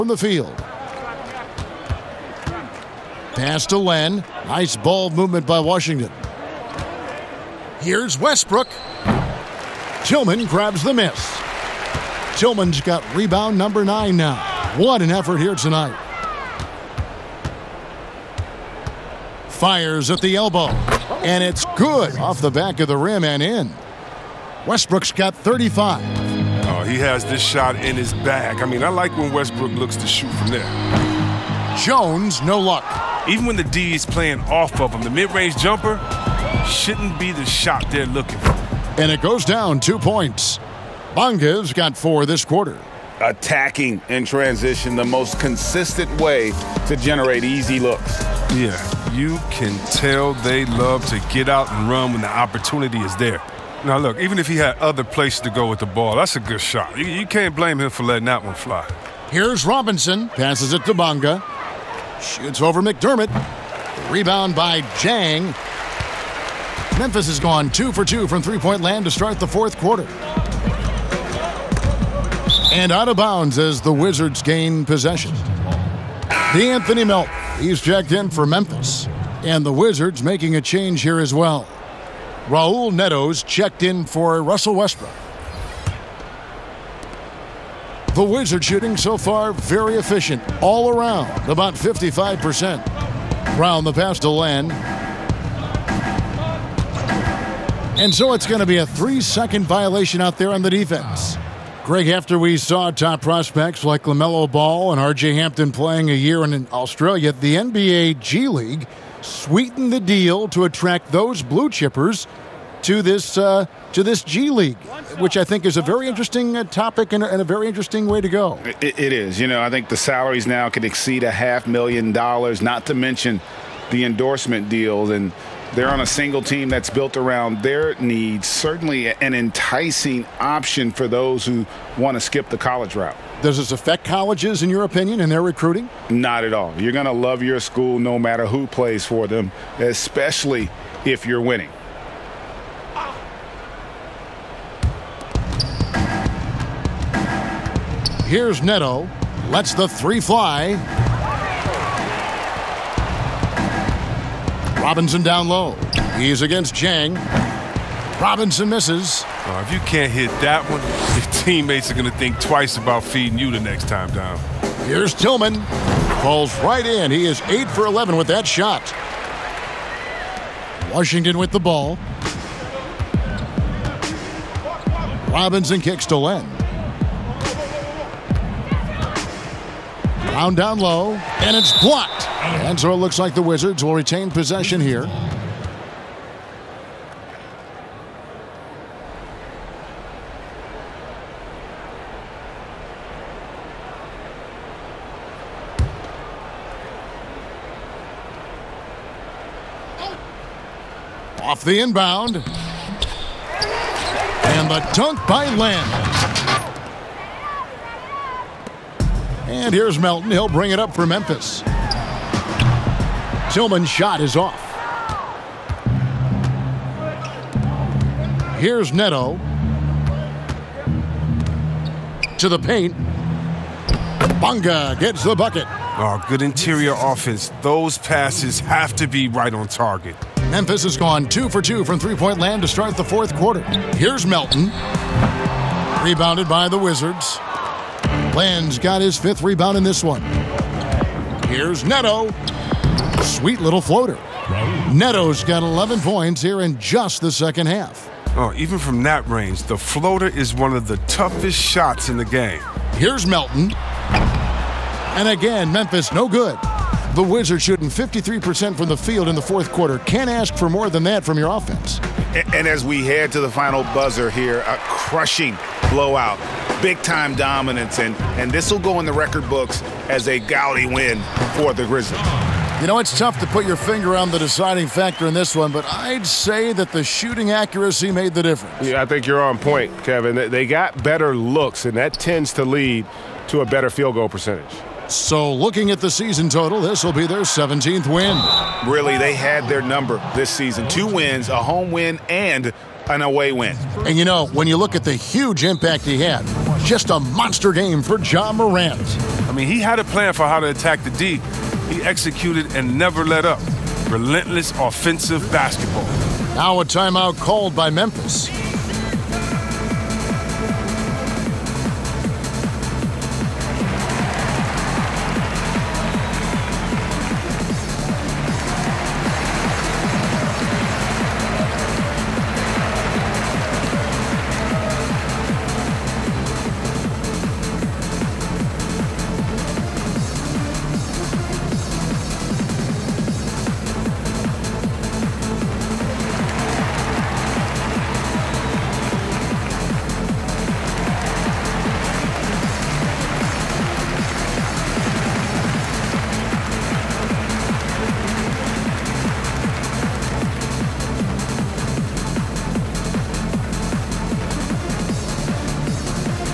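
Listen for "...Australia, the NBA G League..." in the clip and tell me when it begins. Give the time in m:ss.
1:46.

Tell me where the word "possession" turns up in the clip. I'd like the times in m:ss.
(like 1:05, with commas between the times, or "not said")
1:14, 3:04.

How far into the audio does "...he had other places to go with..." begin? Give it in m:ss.
0:54.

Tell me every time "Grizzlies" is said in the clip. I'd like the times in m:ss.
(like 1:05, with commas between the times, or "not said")
4:31.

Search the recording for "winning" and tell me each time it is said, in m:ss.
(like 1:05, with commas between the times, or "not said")
2:21.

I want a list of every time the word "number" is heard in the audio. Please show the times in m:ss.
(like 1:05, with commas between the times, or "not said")
0:13, 4:49.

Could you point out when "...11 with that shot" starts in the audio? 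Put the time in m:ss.
2:47.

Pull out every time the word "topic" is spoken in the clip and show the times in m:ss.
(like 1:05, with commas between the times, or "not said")
1:56.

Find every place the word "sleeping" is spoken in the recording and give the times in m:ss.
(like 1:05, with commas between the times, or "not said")
not said.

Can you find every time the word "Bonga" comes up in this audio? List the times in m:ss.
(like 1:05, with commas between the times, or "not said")
0:41, 1:00, 3:44.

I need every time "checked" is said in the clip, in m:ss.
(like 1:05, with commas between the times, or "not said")
1:17, 1:23.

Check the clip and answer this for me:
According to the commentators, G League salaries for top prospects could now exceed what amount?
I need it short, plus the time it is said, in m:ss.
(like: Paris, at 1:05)
a half million dollars, at 2:01.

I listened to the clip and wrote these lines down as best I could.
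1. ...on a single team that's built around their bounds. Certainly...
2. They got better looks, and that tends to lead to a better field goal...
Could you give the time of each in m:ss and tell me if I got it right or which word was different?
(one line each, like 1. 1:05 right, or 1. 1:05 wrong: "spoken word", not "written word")
1. 2:05 wrong: "needs", not "bounds"
2. 4:40 right.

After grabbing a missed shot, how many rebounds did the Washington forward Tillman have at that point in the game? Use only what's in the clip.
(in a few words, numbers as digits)
9.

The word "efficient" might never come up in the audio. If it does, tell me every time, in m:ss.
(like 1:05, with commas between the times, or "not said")
1:29.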